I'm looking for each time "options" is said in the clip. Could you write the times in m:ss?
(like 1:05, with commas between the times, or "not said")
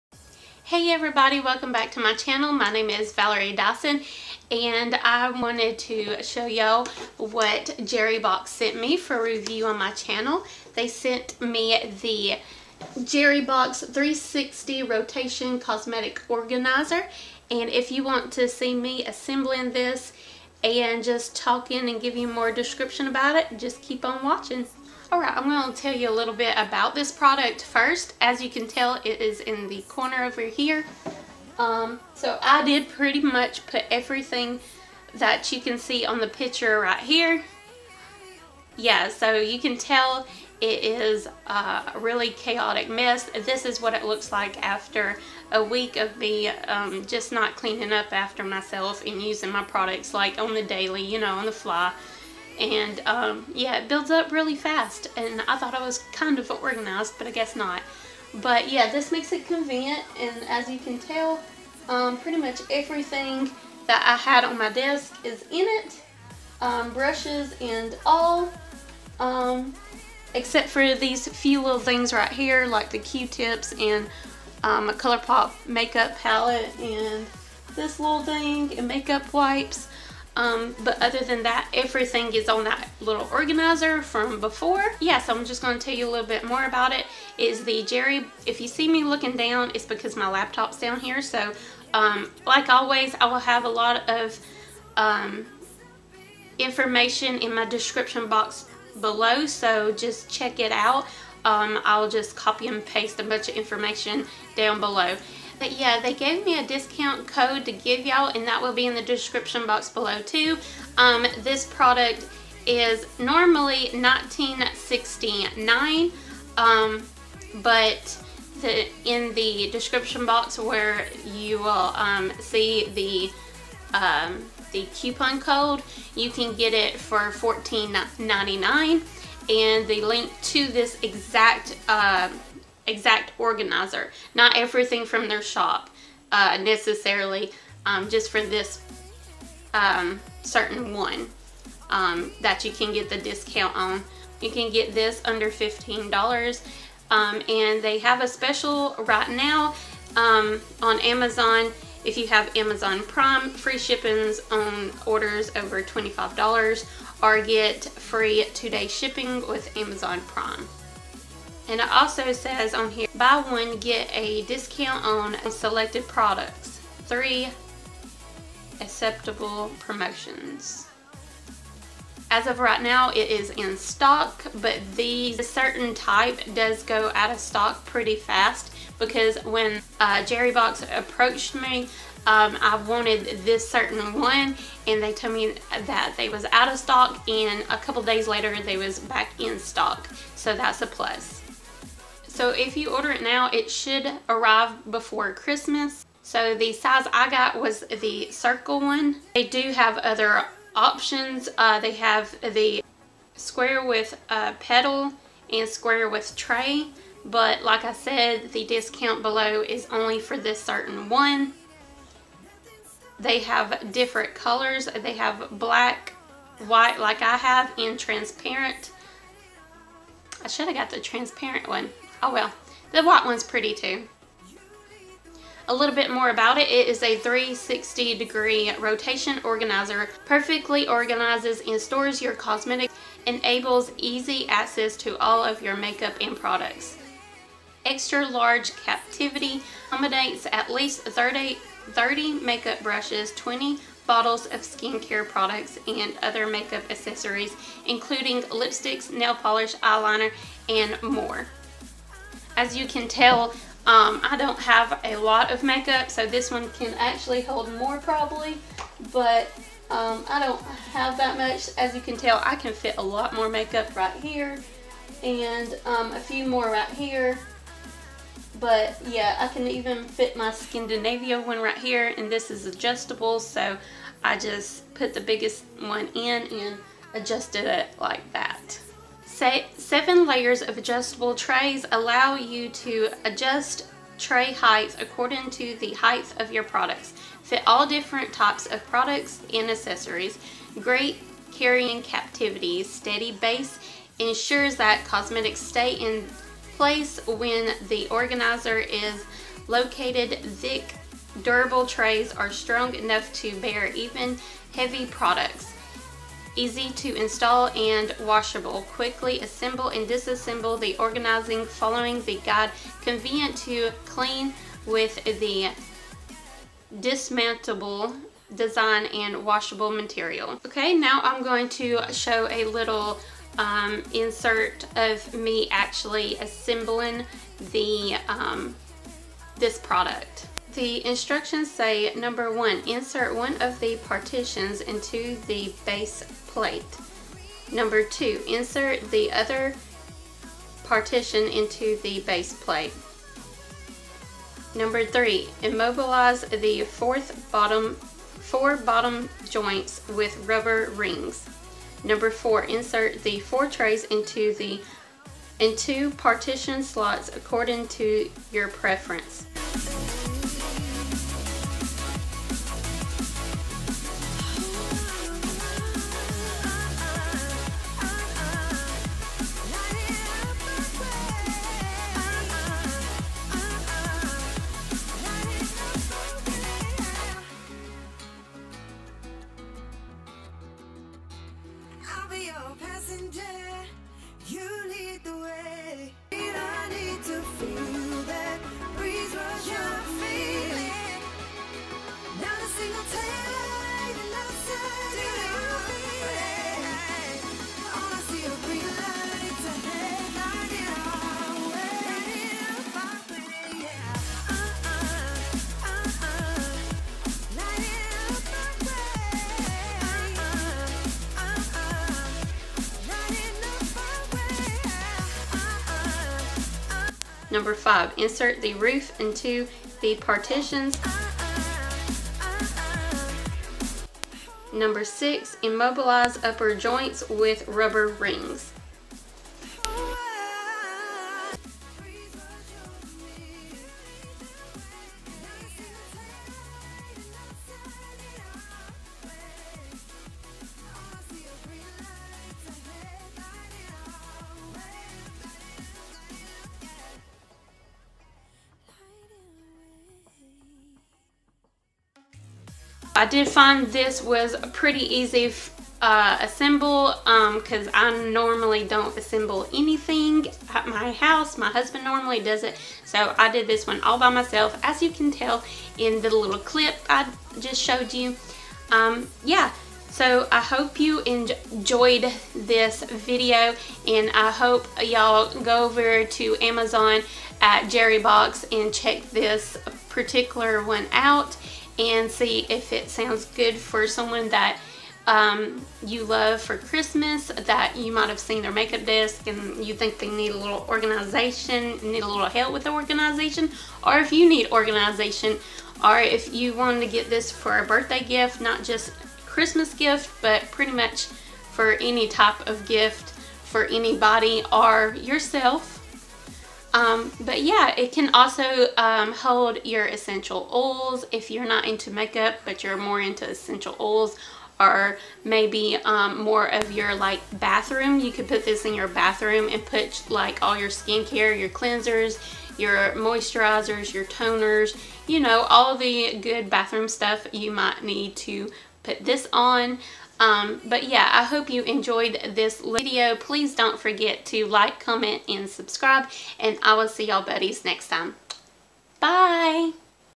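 3:20.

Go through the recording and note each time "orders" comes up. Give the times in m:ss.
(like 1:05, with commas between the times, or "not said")
2:35, 3:12.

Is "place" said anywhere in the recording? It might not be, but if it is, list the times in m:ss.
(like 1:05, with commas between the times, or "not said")
4:56.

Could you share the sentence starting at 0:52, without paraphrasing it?
And um, yeah, it builds up really fast.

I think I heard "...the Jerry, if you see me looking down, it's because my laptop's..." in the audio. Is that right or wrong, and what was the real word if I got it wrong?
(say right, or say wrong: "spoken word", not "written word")
right.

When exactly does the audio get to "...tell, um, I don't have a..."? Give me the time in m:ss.
4:13.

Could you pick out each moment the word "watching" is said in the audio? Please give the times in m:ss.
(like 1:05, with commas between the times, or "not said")
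0:24.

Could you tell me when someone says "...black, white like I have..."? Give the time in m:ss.
3:35.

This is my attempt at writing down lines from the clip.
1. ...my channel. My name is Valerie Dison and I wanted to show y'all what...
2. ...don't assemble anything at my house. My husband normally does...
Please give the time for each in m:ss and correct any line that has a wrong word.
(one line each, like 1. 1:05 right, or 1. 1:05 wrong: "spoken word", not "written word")
1. 0:01 right
2. 7:38 right.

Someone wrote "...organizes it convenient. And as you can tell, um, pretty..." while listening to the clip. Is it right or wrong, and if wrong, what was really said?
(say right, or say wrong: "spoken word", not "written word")
wrong: "makes", not "organizes".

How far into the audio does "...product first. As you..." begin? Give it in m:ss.
0:27.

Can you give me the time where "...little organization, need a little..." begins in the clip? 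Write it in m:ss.
8:10.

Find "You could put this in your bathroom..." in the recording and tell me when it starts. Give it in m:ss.
8:38.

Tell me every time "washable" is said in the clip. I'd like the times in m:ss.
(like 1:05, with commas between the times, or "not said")
5:08, 5:19.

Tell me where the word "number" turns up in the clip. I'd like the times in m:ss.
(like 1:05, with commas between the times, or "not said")
5:32, 5:37, 5:44, 5:52, 6:57, 7:04.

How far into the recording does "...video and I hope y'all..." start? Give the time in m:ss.
7:53.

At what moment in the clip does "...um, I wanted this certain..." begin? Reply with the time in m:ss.
3:02.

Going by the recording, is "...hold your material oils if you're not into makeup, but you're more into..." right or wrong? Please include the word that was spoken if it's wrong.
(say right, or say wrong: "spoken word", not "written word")
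wrong: "essential", not "material".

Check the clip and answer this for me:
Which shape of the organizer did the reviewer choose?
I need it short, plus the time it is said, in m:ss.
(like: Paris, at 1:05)
Circle, at 3:18.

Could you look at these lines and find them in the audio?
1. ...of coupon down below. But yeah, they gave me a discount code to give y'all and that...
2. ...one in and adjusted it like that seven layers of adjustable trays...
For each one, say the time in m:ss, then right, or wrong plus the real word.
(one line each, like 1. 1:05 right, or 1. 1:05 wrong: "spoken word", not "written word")
1. 1:43 wrong: "information", not "coupon"
2. 4:35 right.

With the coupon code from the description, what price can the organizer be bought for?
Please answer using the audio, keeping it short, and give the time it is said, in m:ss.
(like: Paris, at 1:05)
$14.99, at 2:07.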